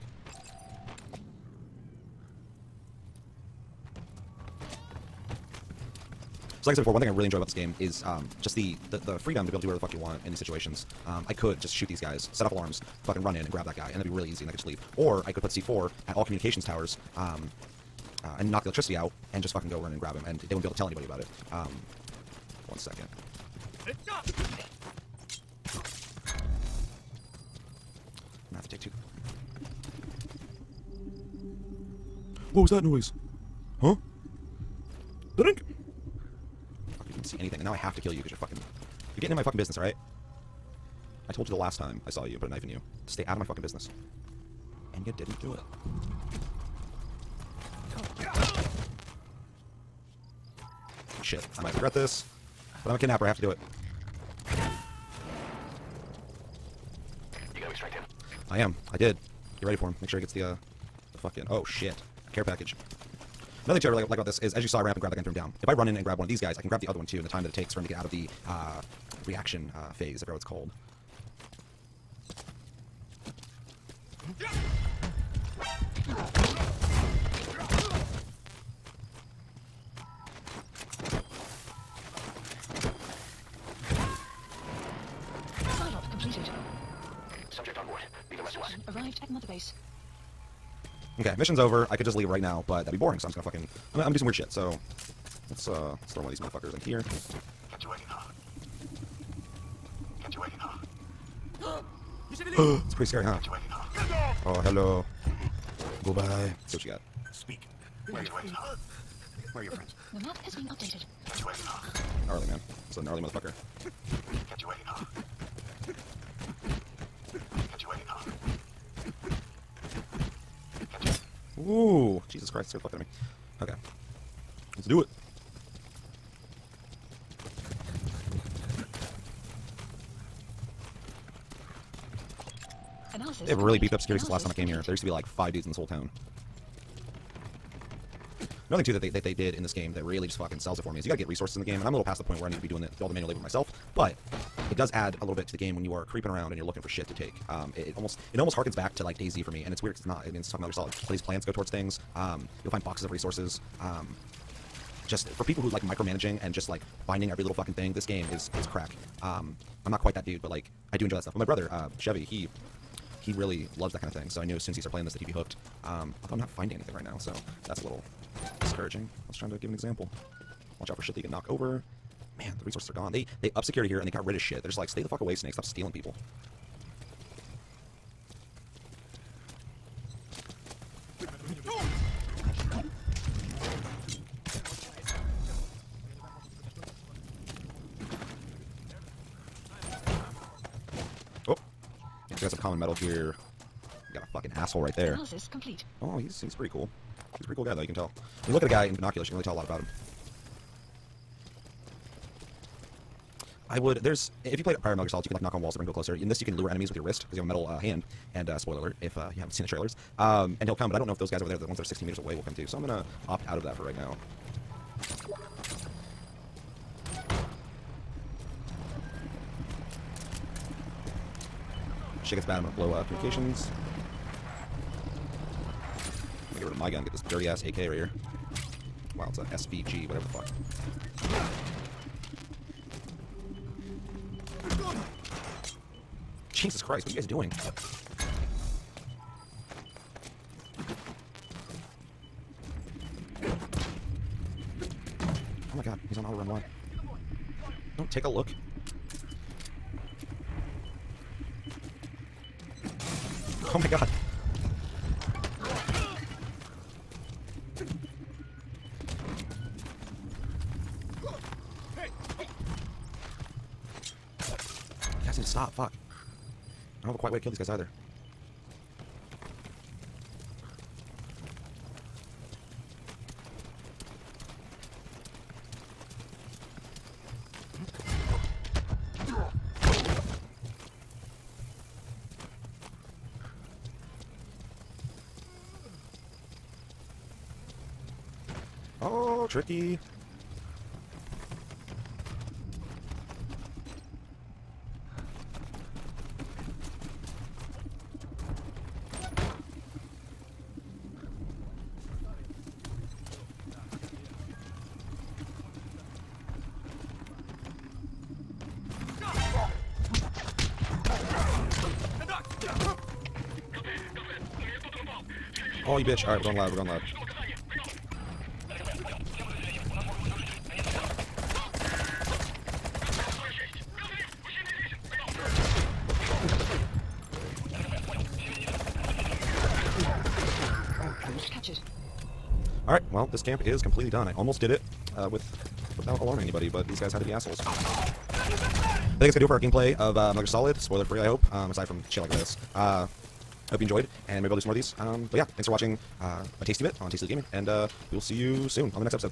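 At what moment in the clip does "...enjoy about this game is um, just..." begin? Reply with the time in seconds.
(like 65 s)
7 s.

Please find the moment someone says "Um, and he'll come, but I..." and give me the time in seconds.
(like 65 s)
210 s.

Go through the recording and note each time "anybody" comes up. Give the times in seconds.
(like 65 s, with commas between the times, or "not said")
20 s, 336 s.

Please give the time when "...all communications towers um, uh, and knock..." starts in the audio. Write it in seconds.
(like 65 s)
16 s.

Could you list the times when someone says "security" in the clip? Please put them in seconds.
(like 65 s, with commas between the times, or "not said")
133 s, 173 s.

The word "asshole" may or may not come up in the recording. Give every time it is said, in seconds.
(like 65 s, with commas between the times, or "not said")
194 s, 337 s.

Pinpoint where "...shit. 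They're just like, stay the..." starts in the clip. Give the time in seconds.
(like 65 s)
174 s.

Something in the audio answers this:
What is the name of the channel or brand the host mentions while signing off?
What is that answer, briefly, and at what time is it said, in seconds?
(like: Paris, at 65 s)
Tasty Gaming, at 347 s.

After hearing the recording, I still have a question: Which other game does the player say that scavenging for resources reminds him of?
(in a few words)
DayZ.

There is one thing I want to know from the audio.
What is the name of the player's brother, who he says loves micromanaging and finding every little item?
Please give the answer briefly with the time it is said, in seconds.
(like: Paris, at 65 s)
Chevy, at 161 s.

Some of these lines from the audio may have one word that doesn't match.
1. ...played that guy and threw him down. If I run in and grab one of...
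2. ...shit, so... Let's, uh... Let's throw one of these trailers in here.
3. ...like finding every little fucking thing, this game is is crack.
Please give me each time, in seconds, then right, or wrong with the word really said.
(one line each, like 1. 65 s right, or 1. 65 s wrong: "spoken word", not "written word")
1. 65 s wrong: "grabbed", not "played"
2. 94 s wrong: "motherfuckers", not "trailers"
3. 156 s right.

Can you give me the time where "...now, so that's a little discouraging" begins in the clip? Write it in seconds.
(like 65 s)
167 s.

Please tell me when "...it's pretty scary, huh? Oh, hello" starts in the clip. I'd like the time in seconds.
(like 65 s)
102 s.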